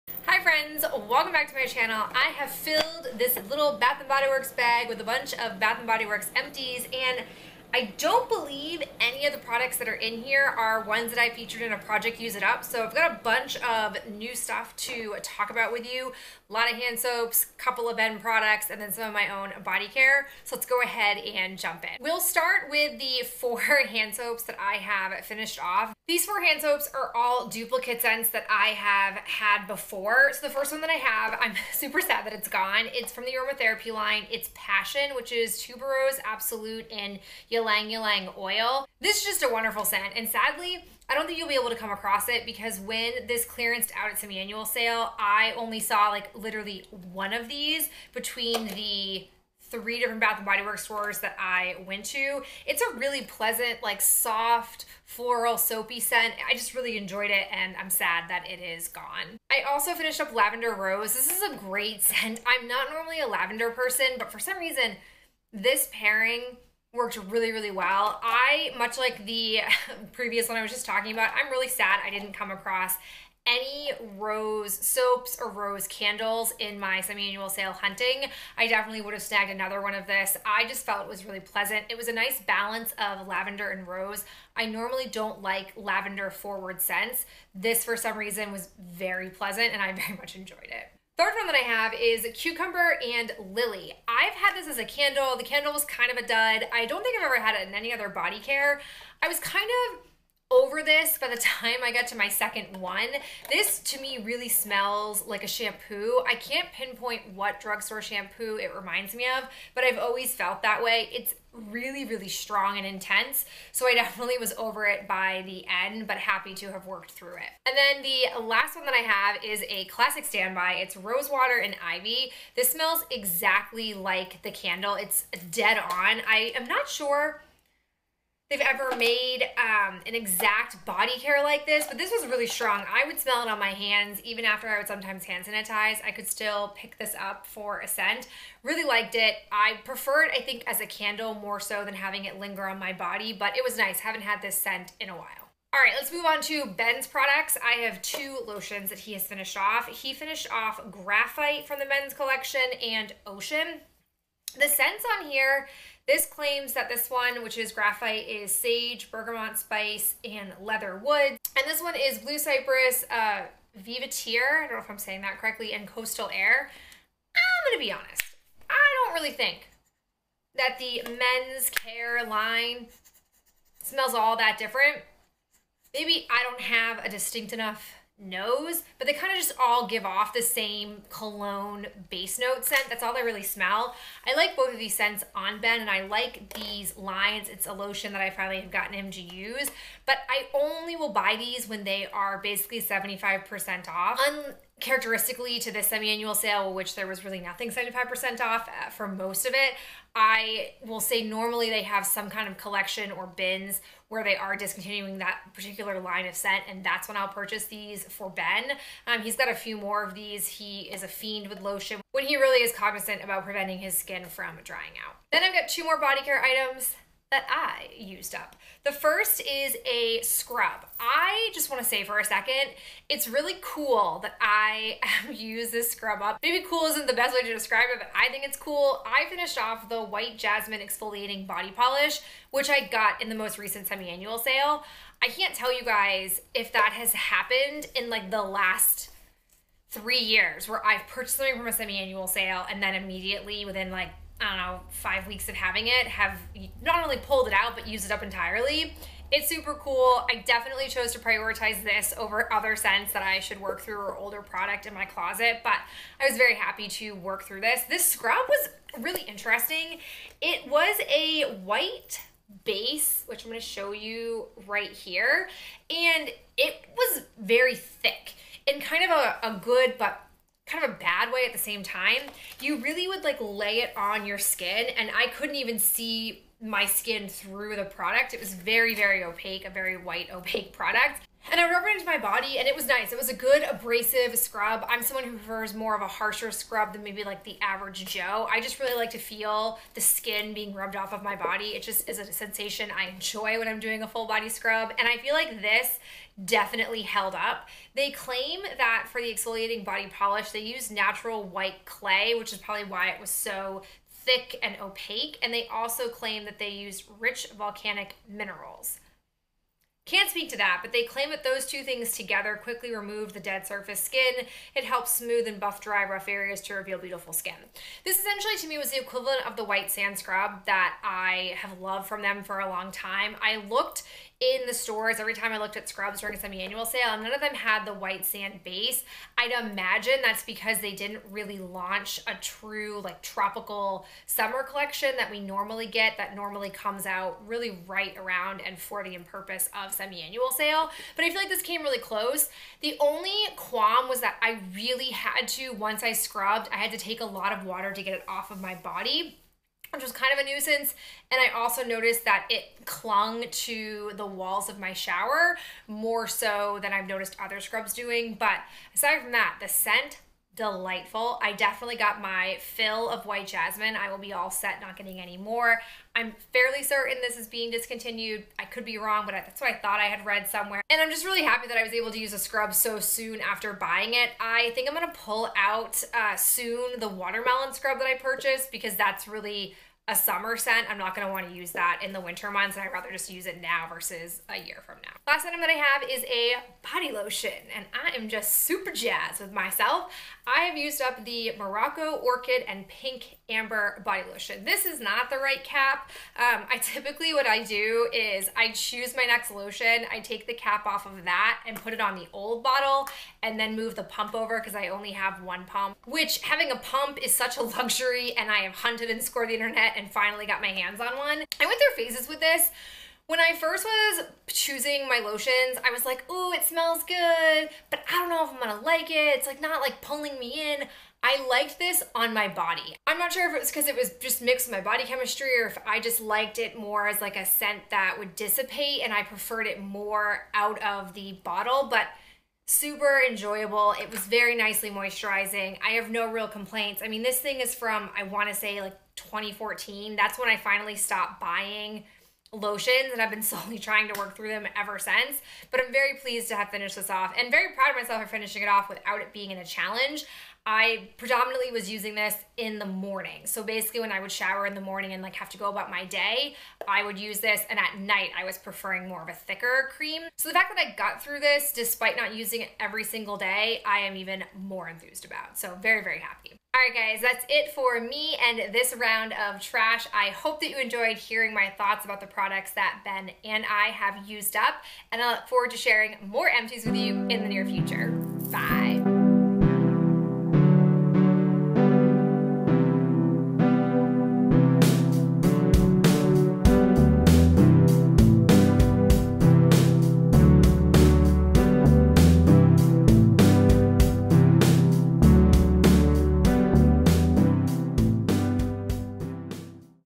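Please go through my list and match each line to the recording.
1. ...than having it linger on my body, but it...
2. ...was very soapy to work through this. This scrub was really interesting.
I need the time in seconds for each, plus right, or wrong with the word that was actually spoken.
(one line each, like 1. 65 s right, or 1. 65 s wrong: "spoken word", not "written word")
1. 141 s right
2. 256 s wrong: "happy", not "soapy".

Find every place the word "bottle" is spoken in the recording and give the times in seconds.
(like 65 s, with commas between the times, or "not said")
402 s, 431 s.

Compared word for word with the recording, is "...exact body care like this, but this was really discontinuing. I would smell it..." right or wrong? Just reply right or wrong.
wrong.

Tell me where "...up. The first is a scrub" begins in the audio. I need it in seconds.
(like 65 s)
218 s.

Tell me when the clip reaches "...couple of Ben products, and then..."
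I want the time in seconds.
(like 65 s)
17 s.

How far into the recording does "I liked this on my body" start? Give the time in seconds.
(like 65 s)
421 s.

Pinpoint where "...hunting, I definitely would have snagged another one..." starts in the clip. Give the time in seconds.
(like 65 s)
77 s.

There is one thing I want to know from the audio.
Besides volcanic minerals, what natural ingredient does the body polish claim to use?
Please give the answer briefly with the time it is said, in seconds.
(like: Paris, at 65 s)
white clay, at 300 s.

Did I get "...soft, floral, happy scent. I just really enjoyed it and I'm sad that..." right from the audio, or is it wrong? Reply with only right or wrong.
wrong.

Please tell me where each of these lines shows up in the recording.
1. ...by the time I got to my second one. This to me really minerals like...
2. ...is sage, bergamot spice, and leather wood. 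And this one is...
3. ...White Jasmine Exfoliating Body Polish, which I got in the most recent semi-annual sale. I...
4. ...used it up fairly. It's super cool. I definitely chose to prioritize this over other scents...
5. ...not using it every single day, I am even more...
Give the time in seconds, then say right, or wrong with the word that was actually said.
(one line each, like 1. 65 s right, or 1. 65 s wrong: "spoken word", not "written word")
1. 101 s wrong: "smells", not "minerals"
2. 158 s right
3. 230 s right
4. 247 s wrong: "entirely", not "fairly"
5. 462 s right.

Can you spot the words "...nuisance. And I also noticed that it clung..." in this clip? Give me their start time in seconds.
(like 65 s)
350 s.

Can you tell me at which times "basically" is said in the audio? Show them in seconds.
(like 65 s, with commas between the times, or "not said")
192 s, 453 s.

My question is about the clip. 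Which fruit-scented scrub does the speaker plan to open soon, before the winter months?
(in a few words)
watermelon.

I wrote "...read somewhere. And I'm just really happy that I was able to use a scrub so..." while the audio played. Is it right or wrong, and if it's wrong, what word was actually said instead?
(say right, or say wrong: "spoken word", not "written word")
right.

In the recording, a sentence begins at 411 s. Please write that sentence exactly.
I went through phases with this.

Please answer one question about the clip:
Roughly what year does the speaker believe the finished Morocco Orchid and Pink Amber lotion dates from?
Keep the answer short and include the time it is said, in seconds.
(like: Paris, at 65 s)
2014, at 439 s.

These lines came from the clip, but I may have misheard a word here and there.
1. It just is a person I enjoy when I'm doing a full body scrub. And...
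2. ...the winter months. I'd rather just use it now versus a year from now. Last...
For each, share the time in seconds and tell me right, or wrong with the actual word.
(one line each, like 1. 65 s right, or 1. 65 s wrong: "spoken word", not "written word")
1. 291 s wrong: "sensation", not "person"
2. 382 s right.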